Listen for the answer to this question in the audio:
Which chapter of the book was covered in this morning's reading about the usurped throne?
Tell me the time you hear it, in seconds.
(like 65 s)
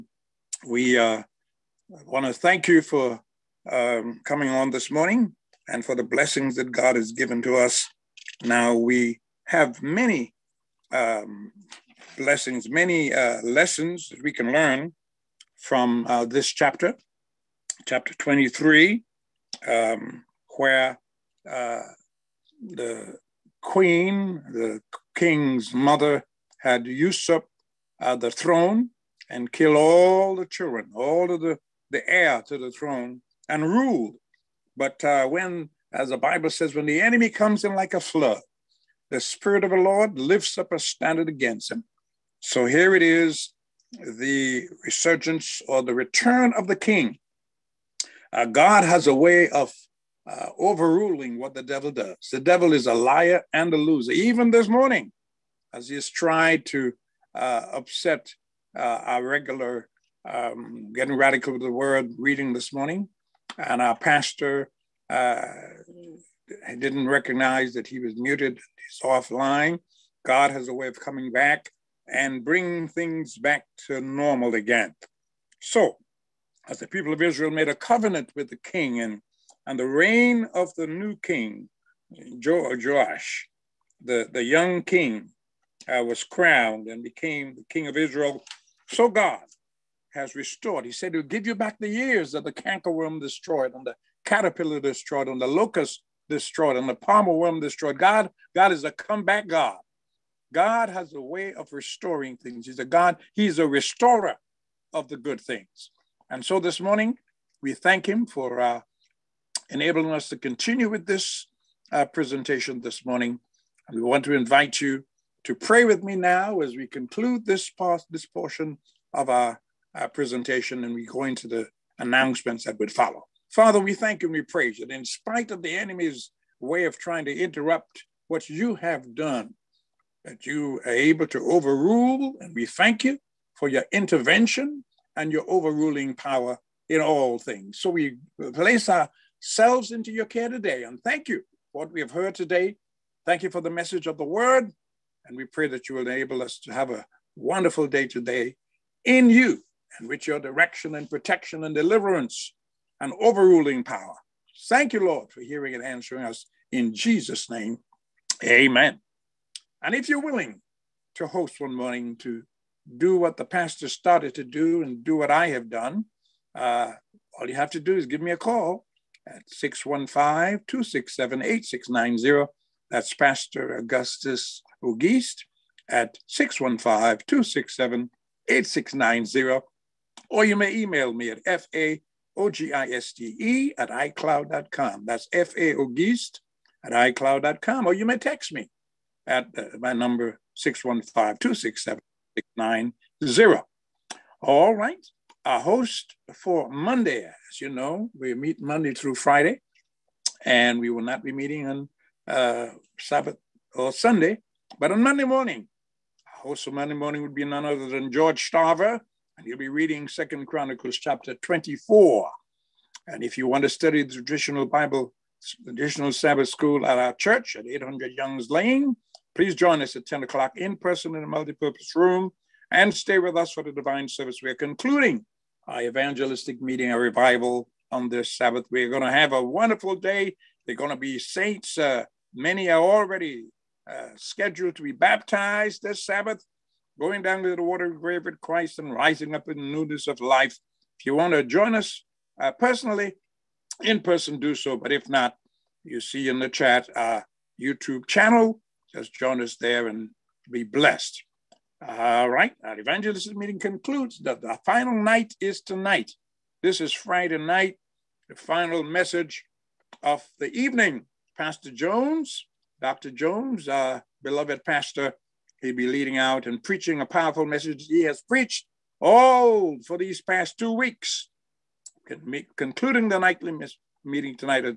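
17 s.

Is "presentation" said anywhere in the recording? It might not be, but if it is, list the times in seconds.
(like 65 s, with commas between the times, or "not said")
112 s, 120 s.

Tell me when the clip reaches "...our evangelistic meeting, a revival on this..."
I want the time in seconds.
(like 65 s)
225 s.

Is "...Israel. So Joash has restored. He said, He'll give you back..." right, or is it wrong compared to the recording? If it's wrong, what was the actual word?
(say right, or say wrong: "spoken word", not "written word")
wrong: "God", not "Joash".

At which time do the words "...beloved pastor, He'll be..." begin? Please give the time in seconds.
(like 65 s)
264 s.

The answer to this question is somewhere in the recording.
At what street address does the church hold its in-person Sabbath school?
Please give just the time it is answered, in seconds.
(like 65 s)
217 s.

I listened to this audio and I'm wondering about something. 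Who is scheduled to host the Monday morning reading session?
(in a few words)
George Starver.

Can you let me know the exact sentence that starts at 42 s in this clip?
So here it is the resurgence or the return of the king.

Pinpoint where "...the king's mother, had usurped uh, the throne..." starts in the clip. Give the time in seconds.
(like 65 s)
24 s.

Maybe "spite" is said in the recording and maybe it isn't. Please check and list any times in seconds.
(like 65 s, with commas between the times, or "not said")
125 s.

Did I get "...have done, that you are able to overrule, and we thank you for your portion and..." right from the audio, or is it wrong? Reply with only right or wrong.
wrong.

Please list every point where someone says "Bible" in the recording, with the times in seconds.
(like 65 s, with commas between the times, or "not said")
36 s, 214 s.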